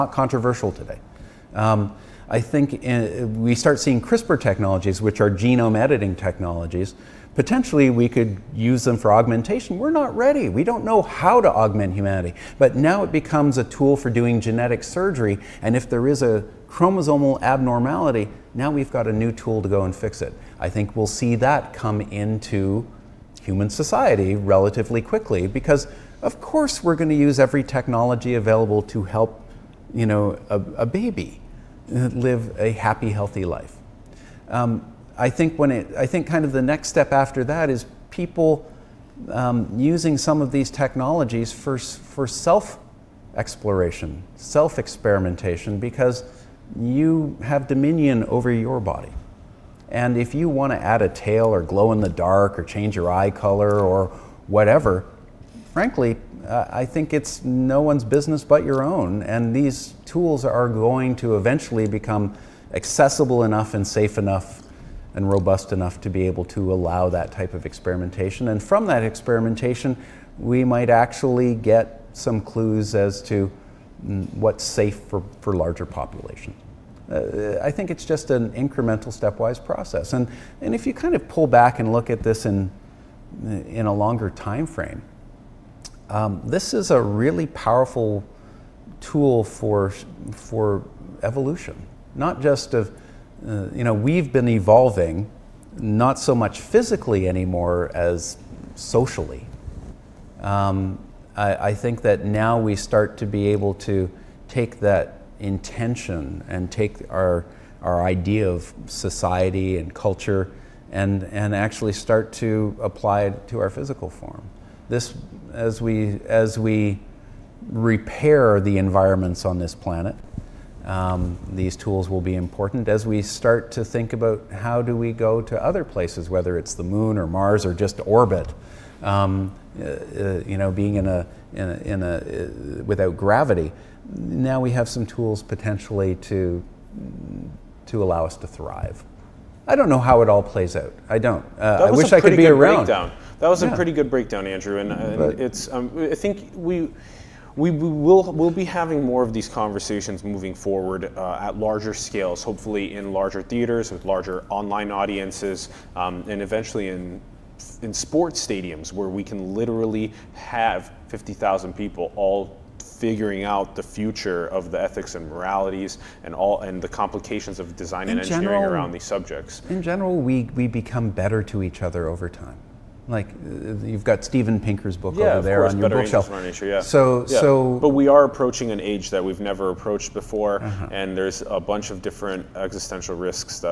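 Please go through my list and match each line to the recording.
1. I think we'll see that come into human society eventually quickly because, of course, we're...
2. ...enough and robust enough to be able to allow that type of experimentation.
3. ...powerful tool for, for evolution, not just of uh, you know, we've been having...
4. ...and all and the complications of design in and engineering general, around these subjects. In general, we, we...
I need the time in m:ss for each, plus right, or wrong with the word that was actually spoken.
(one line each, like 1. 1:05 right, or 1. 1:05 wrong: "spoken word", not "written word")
1. 0:20 wrong: "relatively", not "eventually"
2. 1:04 right
3. 1:27 wrong: "evolving", not "having"
4. 2:46 right.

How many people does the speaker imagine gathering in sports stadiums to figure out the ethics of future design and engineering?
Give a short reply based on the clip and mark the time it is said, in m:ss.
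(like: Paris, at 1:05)
50,000, at 2:41.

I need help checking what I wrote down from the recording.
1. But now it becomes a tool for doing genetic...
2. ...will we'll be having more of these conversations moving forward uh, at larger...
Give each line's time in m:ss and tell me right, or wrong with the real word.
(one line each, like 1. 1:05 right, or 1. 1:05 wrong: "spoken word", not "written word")
1. 0:12 right
2. 2:27 right.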